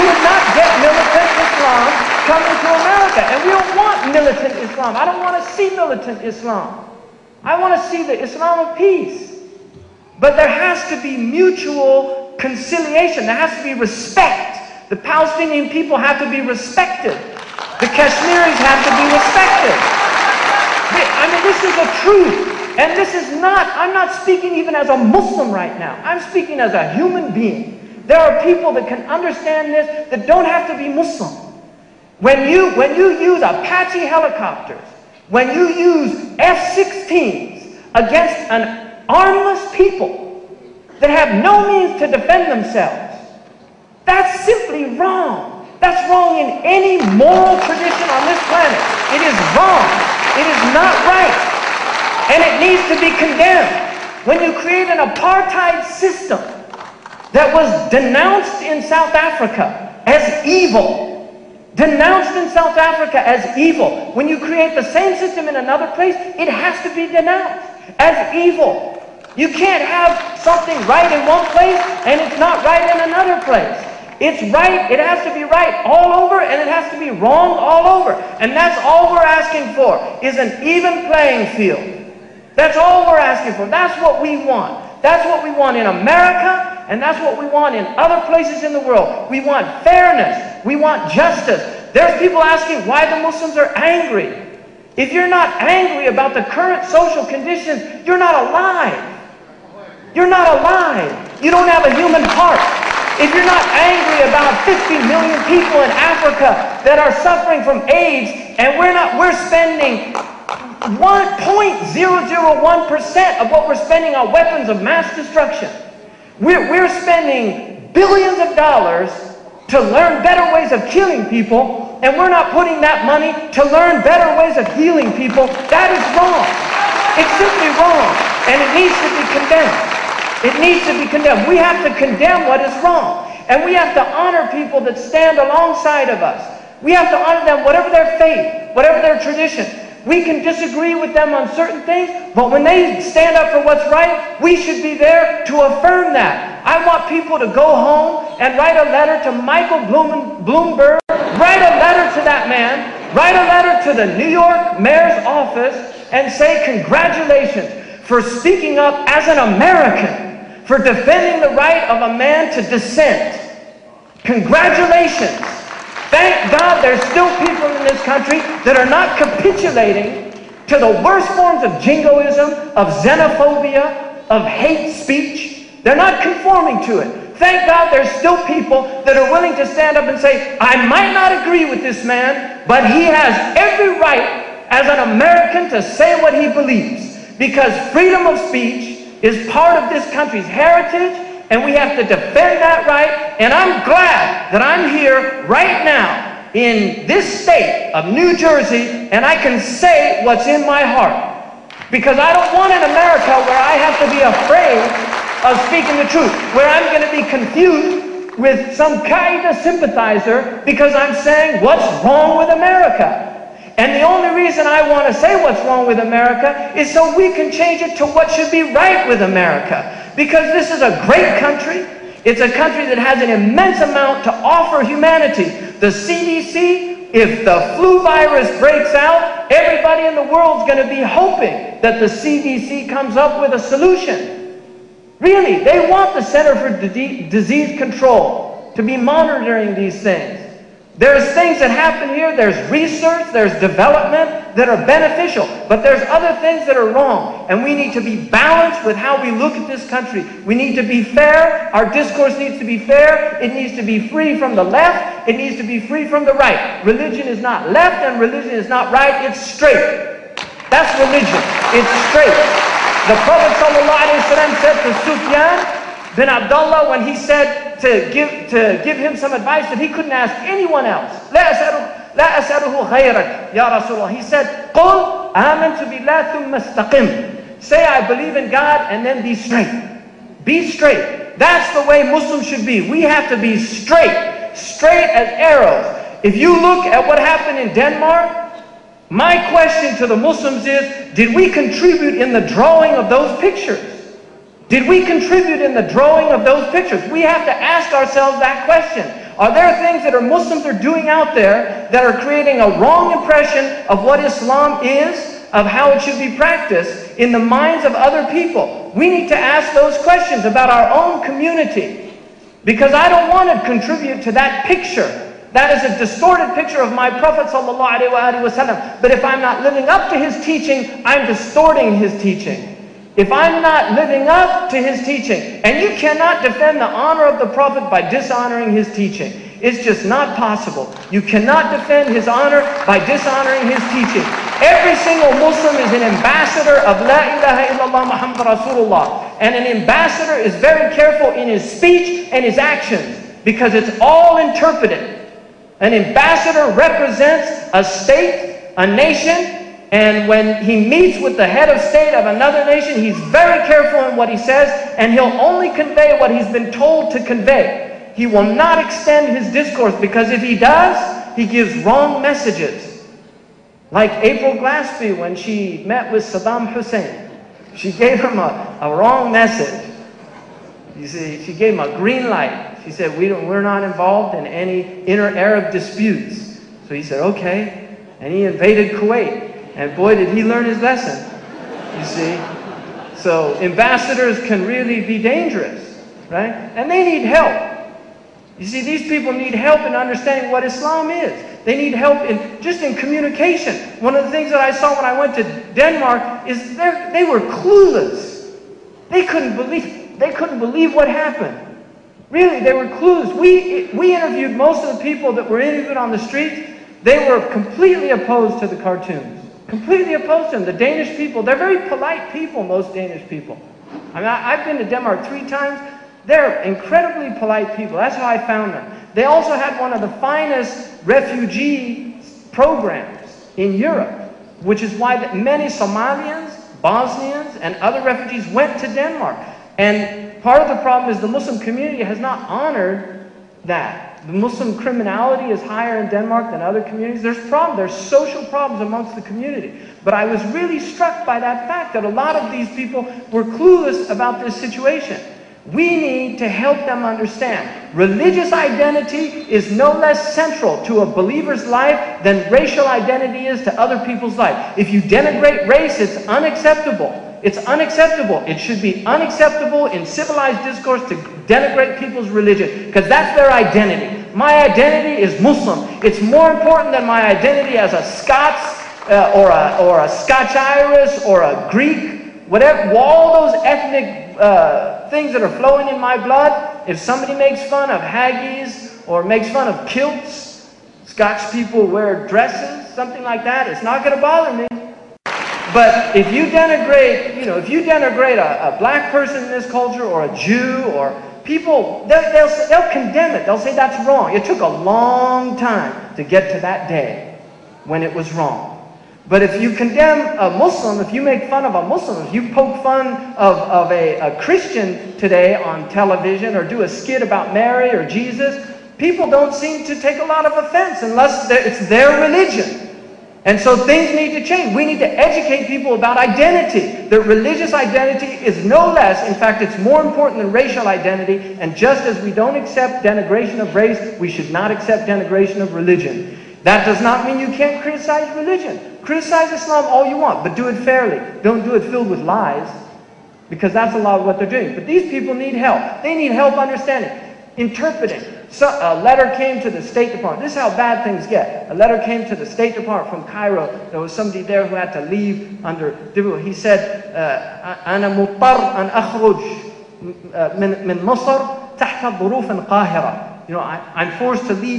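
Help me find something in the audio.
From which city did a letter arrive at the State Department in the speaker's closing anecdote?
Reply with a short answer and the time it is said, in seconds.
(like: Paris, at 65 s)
Cairo, at 543 s.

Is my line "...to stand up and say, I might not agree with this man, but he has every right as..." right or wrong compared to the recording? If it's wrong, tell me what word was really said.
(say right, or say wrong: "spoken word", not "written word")
right.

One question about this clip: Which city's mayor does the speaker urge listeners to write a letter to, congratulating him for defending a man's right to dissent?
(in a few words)
Michael Bloomberg.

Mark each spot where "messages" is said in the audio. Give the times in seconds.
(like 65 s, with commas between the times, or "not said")
362 s, 369 s.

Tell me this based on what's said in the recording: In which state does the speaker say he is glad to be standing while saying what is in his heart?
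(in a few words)
New Jersey.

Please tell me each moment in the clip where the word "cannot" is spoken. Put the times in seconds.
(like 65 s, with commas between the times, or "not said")
325 s, 331 s.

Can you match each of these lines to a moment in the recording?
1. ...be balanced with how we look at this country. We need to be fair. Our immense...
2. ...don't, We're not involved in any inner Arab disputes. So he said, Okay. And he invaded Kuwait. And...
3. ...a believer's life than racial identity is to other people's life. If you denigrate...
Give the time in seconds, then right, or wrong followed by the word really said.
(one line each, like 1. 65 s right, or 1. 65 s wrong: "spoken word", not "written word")
1. 248 s wrong: "discourse", not "immense"
2. 373 s right
3. 451 s right.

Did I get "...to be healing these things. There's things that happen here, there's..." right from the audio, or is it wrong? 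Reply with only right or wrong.
wrong.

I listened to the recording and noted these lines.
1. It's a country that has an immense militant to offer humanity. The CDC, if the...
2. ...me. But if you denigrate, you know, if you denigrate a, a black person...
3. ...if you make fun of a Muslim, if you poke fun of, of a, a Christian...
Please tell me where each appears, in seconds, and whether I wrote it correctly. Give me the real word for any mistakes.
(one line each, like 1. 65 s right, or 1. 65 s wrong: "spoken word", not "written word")
1. 222 s wrong: "amount", not "militant"
2. 484 s right
3. 501 s right.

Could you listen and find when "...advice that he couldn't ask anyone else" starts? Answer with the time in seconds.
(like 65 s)
269 s.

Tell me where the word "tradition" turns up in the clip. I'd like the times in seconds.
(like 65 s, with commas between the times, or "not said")
47 s, 139 s.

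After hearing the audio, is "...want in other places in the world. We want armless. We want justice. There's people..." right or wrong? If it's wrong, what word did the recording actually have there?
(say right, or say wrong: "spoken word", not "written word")
wrong: "fairness", not "armless".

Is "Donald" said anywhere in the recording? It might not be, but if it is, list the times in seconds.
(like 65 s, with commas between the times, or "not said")
not said.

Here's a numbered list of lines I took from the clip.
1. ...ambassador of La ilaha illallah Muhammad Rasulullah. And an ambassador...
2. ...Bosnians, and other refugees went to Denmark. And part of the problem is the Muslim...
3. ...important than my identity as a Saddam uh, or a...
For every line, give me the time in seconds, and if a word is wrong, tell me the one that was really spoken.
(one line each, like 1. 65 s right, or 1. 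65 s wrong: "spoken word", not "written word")
1. 336 s right
2. 426 s right
3. 466 s wrong: "Scots", not "Saddam".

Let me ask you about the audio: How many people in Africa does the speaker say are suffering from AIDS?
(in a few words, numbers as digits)
50 million.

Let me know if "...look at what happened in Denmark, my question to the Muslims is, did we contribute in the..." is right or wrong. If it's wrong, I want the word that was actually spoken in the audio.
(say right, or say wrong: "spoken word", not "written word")
right.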